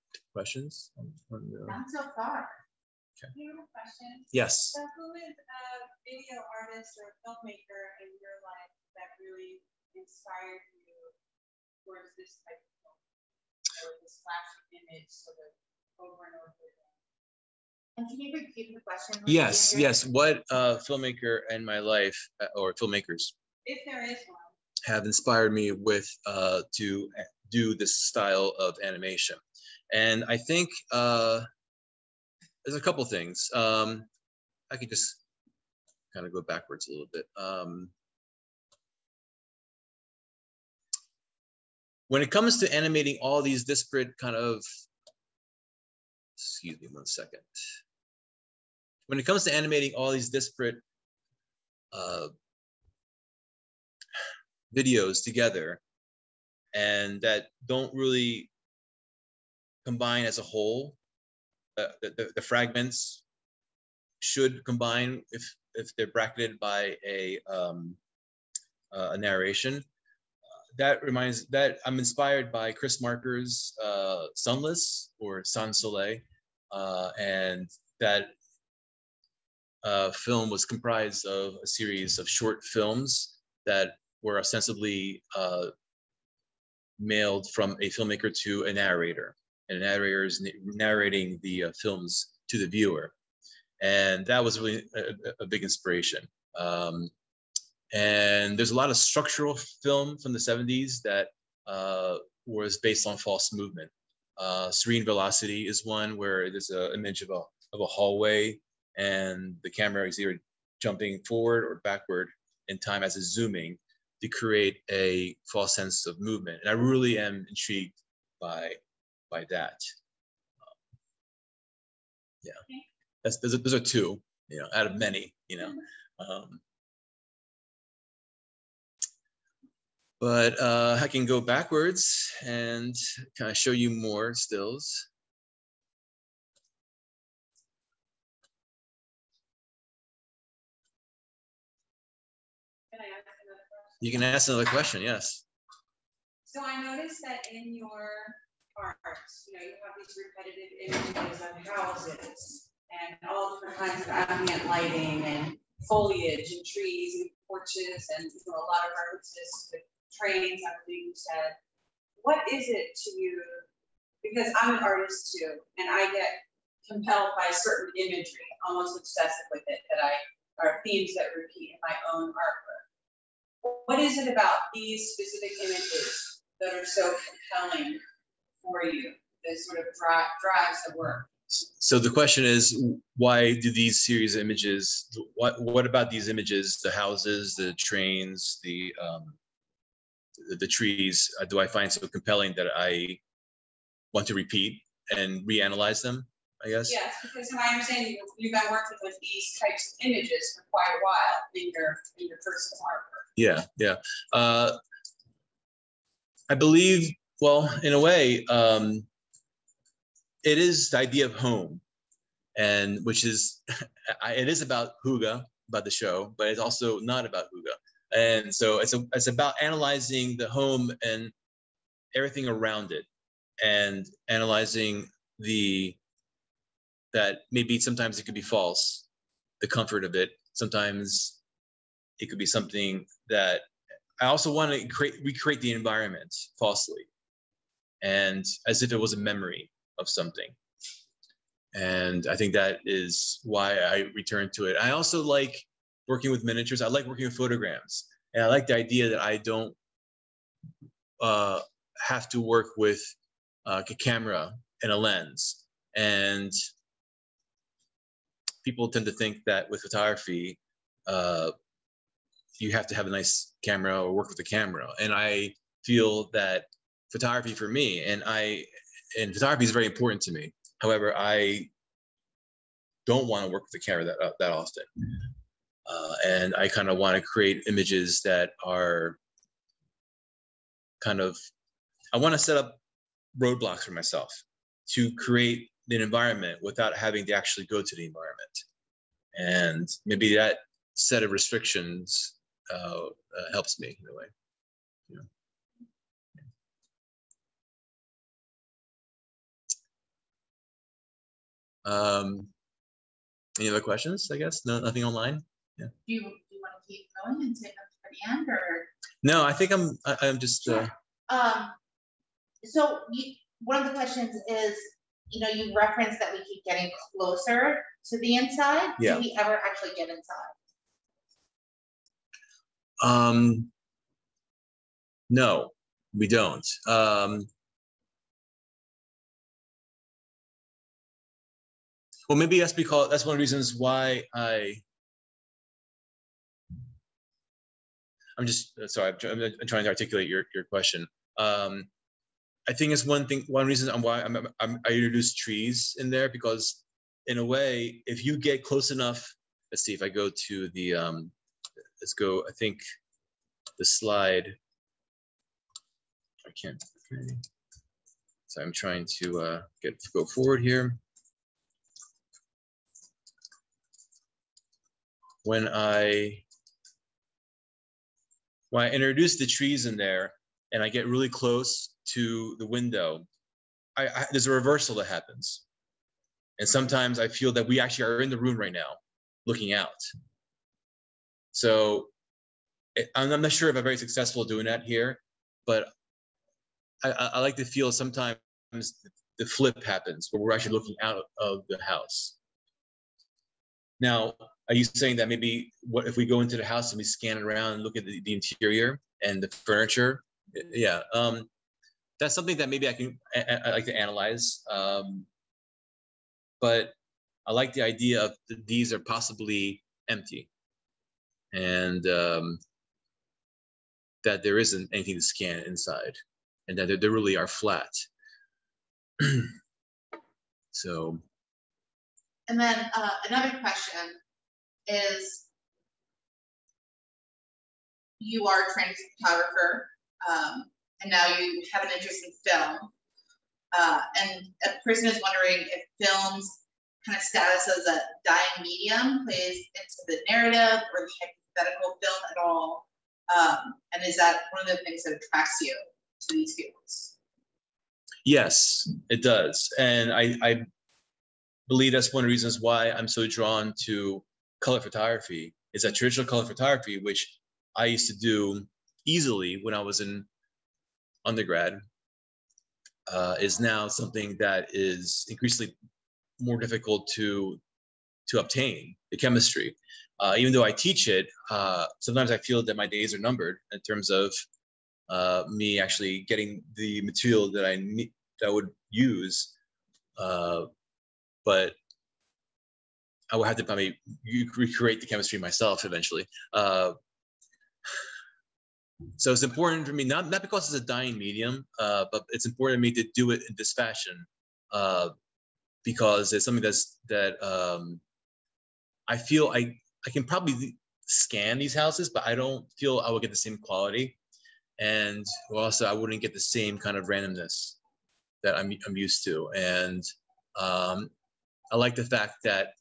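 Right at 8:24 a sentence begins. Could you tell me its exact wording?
And also I wouldn't get the same kind of randomness that I'm, I'm used to.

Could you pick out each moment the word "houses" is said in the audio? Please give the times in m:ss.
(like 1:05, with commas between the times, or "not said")
2:31, 3:06, 6:31, 6:36, 8:21.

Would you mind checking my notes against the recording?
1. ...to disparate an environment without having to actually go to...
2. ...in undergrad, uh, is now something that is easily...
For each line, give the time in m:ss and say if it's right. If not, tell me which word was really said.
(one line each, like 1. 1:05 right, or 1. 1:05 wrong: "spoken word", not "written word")
1. 4:44 wrong: "create", not "disparate"
2. 7:40 wrong: "increasingly", not "easily".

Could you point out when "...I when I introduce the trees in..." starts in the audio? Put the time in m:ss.
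6:05.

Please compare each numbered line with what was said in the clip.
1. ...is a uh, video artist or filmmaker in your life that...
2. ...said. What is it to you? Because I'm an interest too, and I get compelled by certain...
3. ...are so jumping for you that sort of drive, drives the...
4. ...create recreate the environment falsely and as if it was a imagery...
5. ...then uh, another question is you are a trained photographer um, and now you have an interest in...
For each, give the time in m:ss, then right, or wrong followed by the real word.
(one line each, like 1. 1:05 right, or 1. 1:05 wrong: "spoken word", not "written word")
1. 0:05 right
2. 2:41 wrong: "artist", not "interest"
3. 2:56 wrong: "compelling", not "jumping"
4. 3:54 wrong: "memory", not "imagery"
5. 7:02 right.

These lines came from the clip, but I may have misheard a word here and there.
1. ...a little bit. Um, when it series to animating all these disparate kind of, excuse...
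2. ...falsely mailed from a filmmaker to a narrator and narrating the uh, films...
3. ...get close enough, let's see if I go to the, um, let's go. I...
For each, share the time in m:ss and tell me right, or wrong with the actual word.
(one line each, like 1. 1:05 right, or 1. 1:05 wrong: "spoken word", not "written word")
1. 0:36 wrong: "comes", not "series"
2. 1:24 wrong: "ostensibly", not "falsely"
3. 5:48 right.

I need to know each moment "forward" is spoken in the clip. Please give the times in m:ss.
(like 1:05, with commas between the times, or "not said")
1:51, 6:00.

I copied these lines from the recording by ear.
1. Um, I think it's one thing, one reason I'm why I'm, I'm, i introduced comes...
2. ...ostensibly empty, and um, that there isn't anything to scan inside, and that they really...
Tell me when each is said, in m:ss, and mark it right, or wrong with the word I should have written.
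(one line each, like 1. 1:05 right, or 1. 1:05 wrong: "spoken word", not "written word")
1. 5:41 wrong: "trees", not "comes"
2. 6:48 wrong: "possibly", not "ostensibly".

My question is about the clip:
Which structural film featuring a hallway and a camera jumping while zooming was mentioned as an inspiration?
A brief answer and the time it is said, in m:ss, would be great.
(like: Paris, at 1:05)
Serene Velocity, at 1:44.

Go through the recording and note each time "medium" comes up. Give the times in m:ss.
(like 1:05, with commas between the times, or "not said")
7:18, 8:11.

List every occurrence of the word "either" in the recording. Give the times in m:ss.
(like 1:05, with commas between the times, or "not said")
1:50.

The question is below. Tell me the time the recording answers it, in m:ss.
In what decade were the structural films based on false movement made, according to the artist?
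1:40.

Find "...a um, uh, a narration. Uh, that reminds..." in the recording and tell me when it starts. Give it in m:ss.
1:07.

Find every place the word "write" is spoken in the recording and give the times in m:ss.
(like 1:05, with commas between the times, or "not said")
not said.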